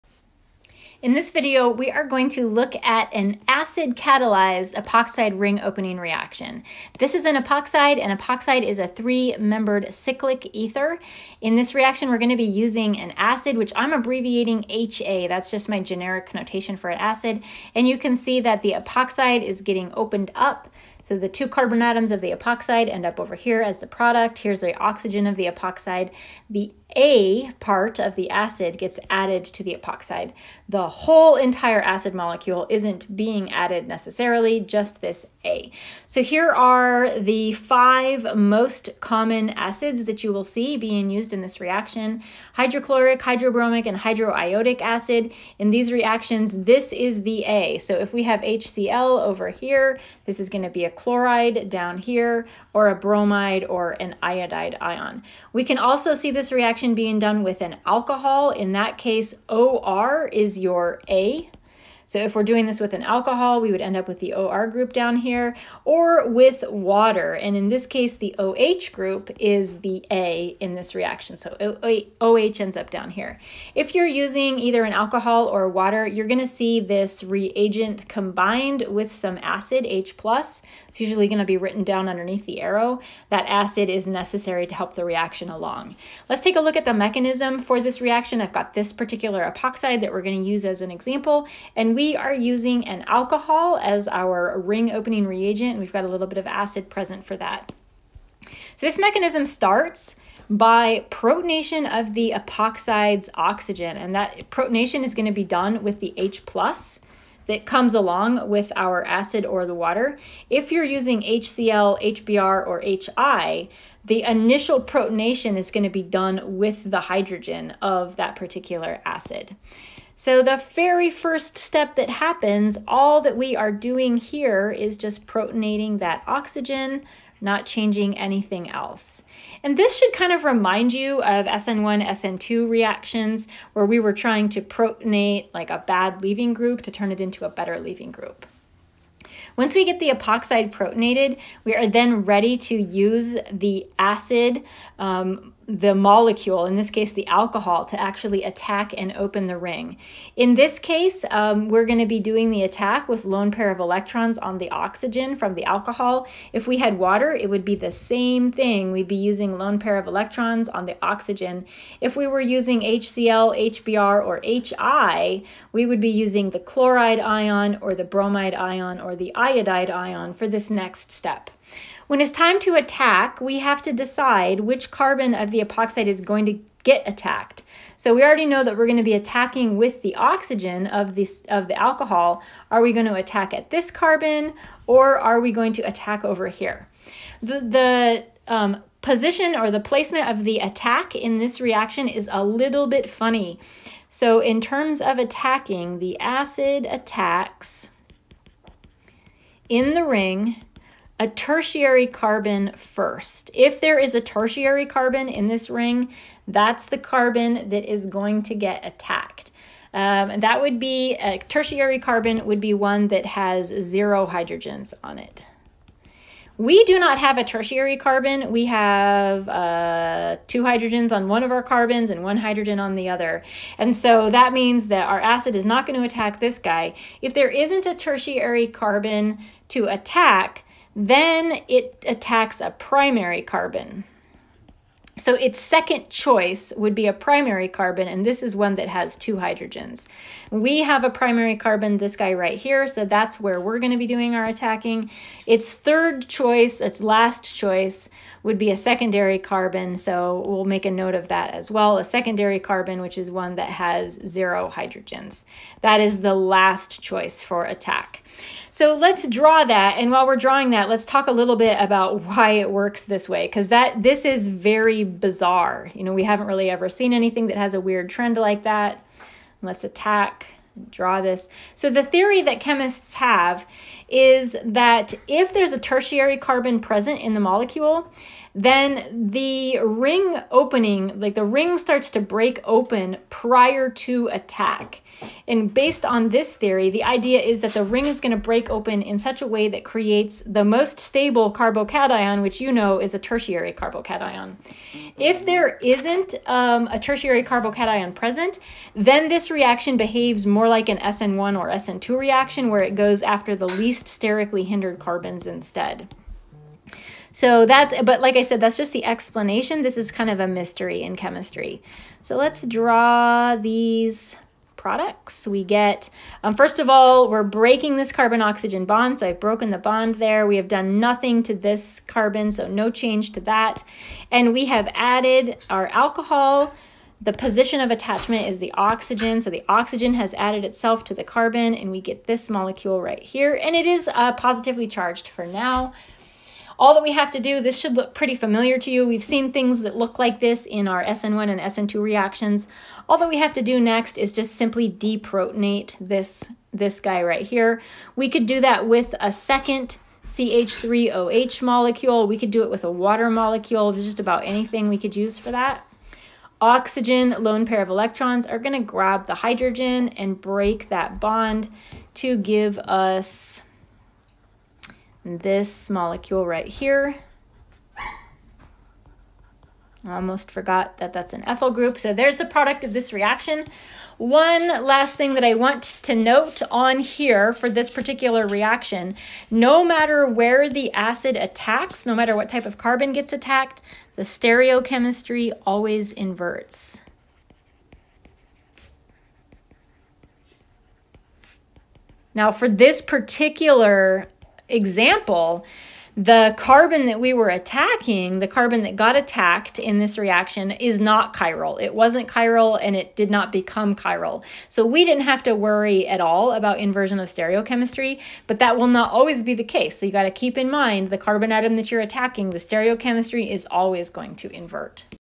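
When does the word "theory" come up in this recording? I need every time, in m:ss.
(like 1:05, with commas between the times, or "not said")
4:32, 4:46.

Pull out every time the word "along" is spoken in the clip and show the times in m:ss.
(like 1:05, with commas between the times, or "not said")
1:25, 1:47.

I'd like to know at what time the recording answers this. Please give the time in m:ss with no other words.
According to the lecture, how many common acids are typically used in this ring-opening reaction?
0:37.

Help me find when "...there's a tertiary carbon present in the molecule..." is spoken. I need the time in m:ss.
4:35.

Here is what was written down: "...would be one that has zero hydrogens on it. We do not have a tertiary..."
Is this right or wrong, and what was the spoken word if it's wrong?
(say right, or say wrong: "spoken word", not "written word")
right.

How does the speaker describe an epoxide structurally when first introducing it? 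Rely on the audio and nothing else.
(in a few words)
three-membered cyclic ether.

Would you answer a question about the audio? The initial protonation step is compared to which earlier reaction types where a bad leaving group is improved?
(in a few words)
SN1, SN2 reactions.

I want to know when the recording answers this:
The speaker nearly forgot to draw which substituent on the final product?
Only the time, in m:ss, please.
6:11.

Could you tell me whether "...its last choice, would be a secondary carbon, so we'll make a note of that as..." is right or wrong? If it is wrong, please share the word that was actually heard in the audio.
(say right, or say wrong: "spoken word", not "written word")
right.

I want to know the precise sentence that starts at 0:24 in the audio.
Here's the oxygen of the epoxide.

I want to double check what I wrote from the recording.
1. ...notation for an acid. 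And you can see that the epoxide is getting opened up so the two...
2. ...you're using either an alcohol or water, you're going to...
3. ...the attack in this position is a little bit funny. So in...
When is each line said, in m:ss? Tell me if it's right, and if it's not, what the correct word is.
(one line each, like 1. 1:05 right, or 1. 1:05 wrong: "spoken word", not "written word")
1. 0:16 right
2. 1:13 right
3. 3:10 wrong: "reaction", not "position".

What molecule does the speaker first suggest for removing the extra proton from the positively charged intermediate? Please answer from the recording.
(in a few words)
CH3OH.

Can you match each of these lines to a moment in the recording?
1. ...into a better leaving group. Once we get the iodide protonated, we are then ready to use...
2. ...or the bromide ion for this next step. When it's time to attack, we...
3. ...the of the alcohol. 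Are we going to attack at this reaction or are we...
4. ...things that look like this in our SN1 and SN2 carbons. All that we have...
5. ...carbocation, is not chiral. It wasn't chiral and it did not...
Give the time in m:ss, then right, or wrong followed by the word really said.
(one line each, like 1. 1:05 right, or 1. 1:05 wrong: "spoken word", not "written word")
1. 2:17 wrong: "epoxide", not "iodide"
2. 2:48 wrong: "iodide", not "bromide"
3. 3:01 wrong: "carbon", not "reaction"
4. 5:39 wrong: "reactions", not "carbons"
5. 6:40 wrong: "reaction", not "carbocation".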